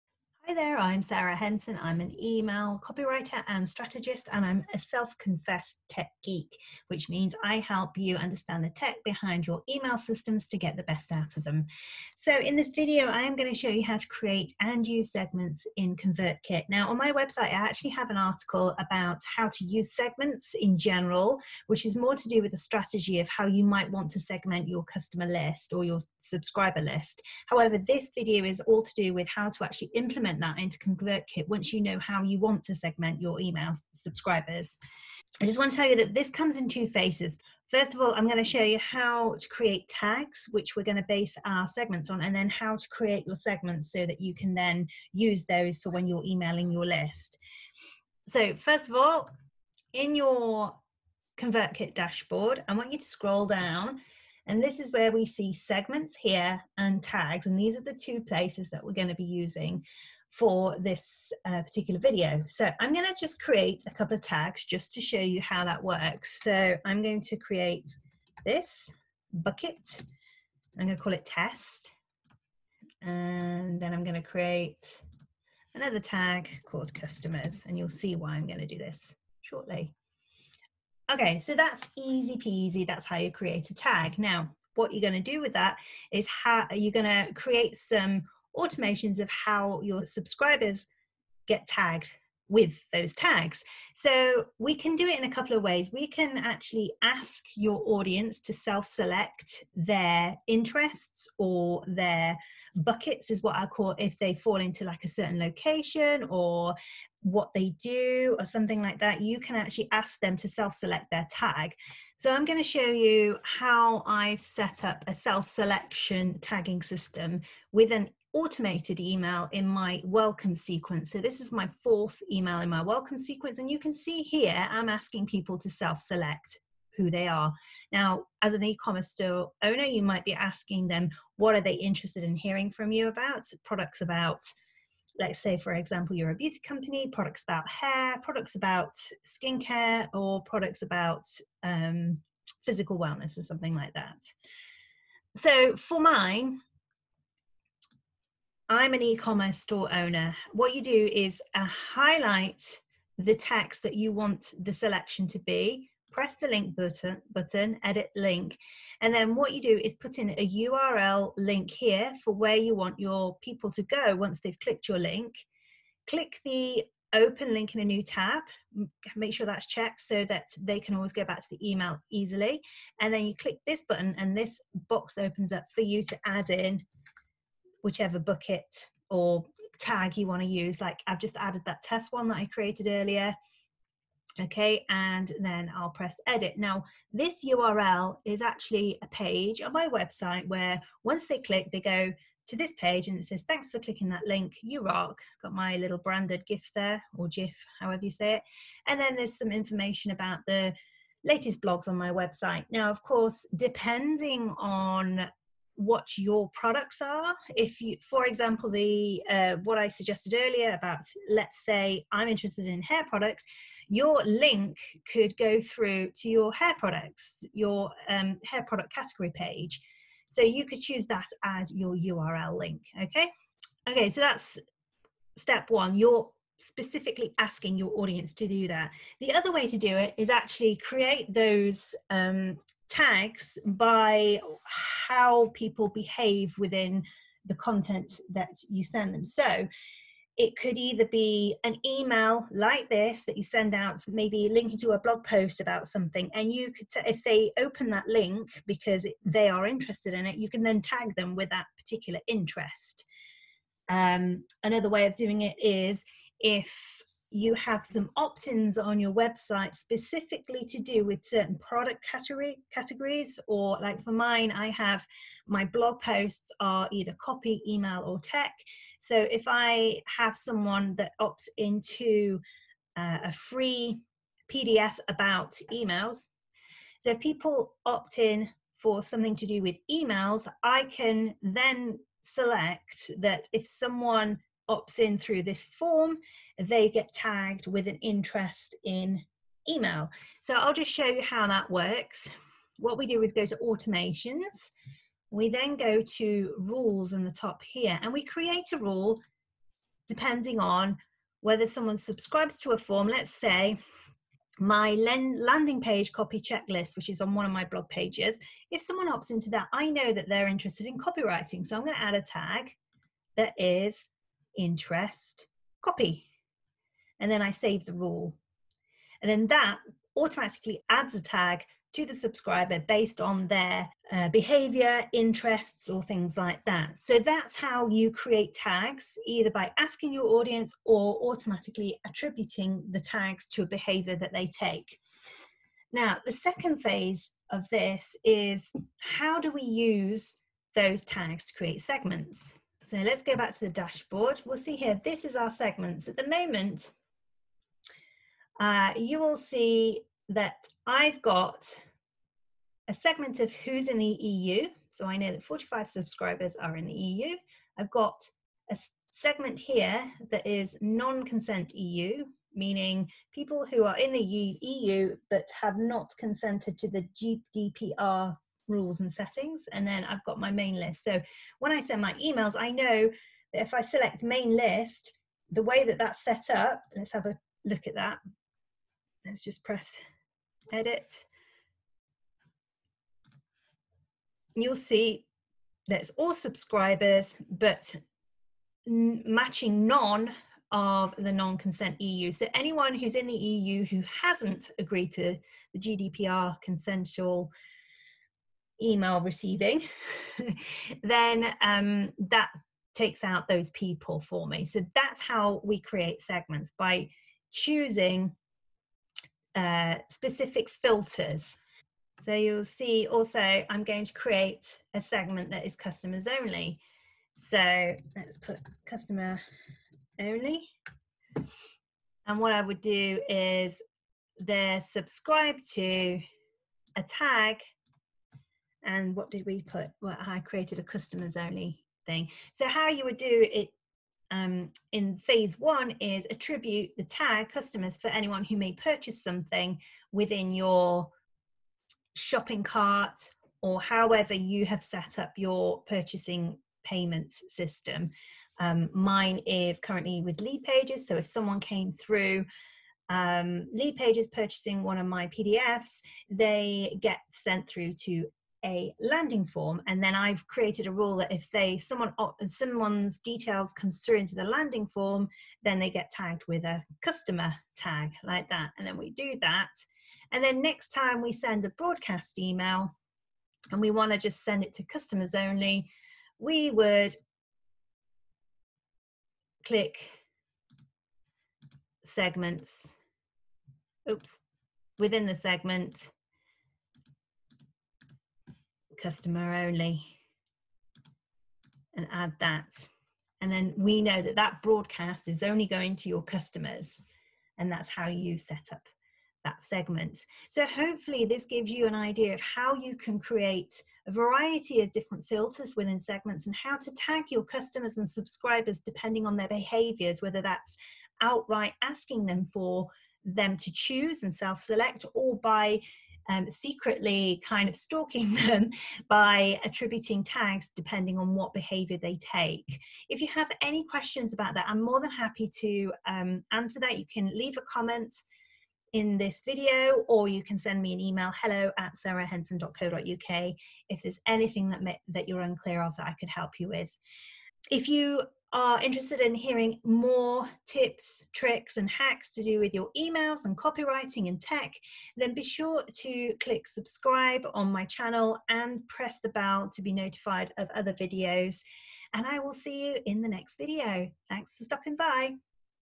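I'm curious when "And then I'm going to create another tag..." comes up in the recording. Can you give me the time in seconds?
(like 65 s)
73 s.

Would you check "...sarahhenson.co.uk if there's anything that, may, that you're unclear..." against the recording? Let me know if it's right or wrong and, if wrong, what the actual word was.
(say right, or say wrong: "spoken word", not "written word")
right.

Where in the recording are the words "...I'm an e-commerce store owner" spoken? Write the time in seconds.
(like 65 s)
148 s.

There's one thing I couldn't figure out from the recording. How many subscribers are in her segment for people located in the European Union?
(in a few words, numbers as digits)
45.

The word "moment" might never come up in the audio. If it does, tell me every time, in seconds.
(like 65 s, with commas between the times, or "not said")
346 s.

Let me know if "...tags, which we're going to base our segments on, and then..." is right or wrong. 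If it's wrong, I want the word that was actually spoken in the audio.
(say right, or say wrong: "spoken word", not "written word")
right.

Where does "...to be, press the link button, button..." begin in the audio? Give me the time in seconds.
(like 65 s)
155 s.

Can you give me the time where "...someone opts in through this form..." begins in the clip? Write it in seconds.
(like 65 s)
283 s.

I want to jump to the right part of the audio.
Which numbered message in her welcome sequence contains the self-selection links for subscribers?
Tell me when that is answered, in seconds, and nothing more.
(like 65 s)
121 s.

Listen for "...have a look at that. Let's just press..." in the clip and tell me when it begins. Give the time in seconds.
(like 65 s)
377 s.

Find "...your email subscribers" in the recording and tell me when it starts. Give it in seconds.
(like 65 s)
33 s.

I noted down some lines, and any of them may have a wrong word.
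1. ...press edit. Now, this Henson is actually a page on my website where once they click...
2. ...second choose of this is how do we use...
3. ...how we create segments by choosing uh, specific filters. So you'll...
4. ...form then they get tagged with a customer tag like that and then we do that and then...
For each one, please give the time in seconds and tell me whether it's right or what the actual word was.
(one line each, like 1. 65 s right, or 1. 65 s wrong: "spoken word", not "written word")
1. 185 s wrong: "URL", not "Henson"
2. 336 s wrong: "phase", not "choose"
3. 405 s right
4. 464 s right.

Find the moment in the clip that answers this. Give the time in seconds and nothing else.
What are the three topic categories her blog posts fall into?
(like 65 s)
267 s.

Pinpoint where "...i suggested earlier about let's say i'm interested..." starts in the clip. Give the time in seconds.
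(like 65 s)
209 s.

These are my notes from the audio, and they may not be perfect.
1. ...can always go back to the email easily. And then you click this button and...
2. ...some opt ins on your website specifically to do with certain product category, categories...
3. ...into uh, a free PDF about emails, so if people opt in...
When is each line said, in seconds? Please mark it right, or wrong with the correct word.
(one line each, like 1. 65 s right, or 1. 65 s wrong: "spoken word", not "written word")
1. 170 s right
2. 257 s right
3. 271 s right.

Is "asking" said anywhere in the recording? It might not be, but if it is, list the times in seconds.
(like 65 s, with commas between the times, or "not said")
124 s, 130 s, 227 s, 329 s, 511 s.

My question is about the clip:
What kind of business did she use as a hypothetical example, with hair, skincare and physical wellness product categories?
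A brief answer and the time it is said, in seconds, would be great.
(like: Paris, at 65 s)
beauty company, at 136 s.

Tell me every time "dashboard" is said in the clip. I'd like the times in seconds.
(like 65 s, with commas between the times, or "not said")
51 s, 343 s.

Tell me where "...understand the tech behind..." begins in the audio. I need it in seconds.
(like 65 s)
8 s.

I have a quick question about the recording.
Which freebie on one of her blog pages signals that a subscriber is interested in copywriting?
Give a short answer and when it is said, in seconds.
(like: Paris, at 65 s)
landing page copy checklist, at 304 s.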